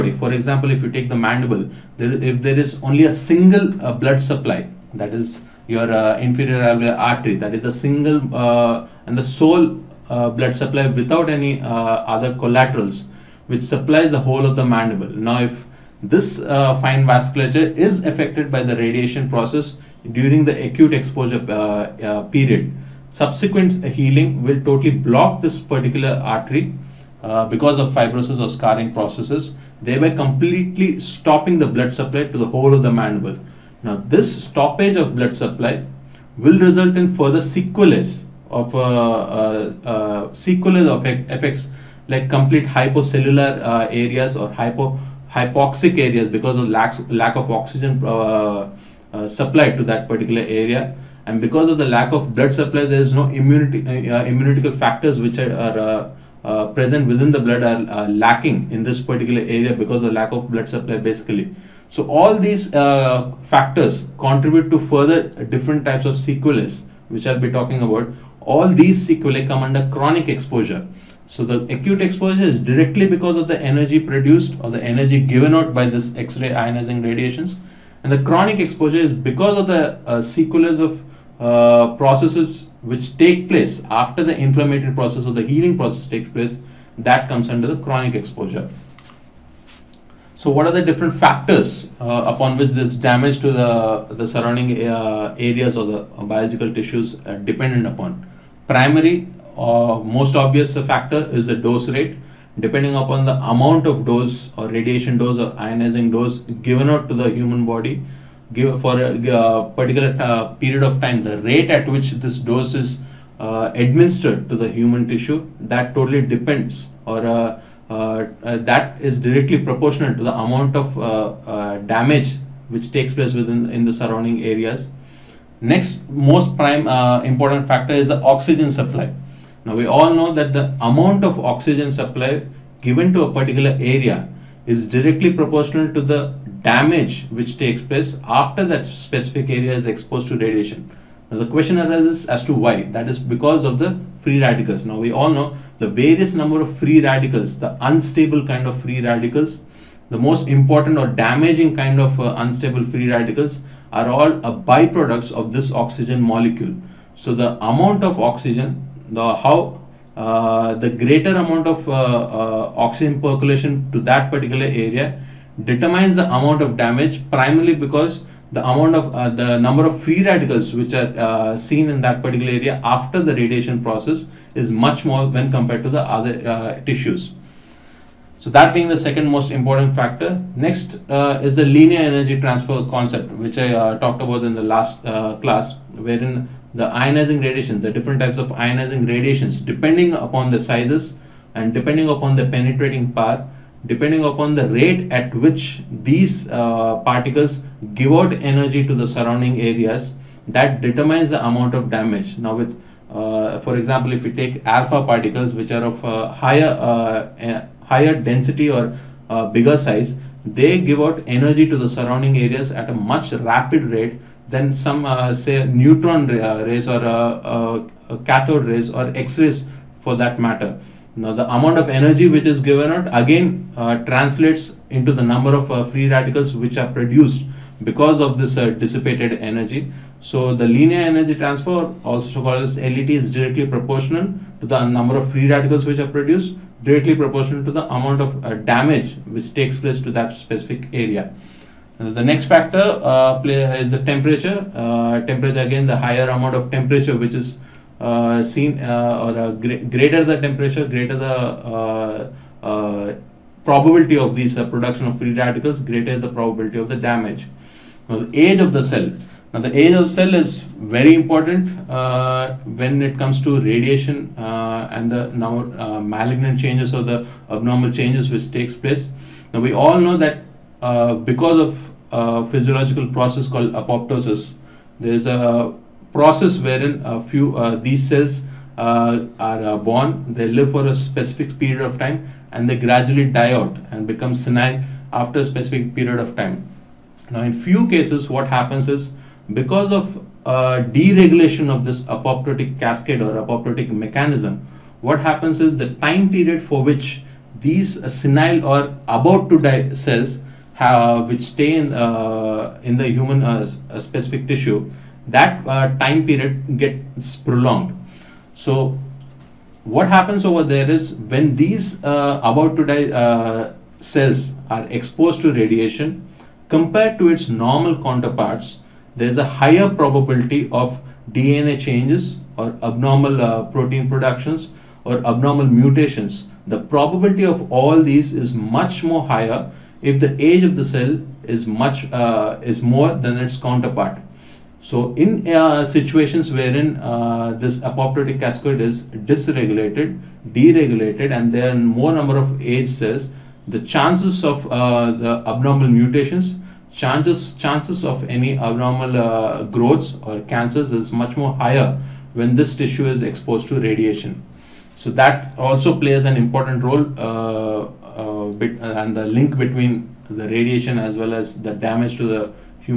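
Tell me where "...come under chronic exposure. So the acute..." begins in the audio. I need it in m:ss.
1:09.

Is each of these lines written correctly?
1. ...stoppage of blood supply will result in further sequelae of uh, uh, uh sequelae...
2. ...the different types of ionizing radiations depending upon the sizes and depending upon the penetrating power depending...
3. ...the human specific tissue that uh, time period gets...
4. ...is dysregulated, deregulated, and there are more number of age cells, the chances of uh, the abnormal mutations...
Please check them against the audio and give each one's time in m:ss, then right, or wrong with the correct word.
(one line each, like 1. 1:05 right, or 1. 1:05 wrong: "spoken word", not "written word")
1. 0:34 right
2. 3:07 right
3. 5:02 right
4. 5:38 right.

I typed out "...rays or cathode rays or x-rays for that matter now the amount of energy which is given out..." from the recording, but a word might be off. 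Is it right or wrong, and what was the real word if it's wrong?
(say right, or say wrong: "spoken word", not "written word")
right.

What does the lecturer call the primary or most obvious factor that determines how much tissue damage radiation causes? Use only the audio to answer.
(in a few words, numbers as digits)
Dose rate.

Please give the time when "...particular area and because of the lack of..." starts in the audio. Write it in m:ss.
0:50.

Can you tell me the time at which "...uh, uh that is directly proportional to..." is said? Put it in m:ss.
1:57.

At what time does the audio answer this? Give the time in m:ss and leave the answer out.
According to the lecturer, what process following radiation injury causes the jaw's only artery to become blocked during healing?
0:27.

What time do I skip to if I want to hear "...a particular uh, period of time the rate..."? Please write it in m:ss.
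1:49.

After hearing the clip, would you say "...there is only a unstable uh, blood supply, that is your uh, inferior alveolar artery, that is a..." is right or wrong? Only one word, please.
wrong.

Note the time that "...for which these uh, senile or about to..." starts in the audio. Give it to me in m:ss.
4:56.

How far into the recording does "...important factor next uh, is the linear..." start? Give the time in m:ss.
2:59.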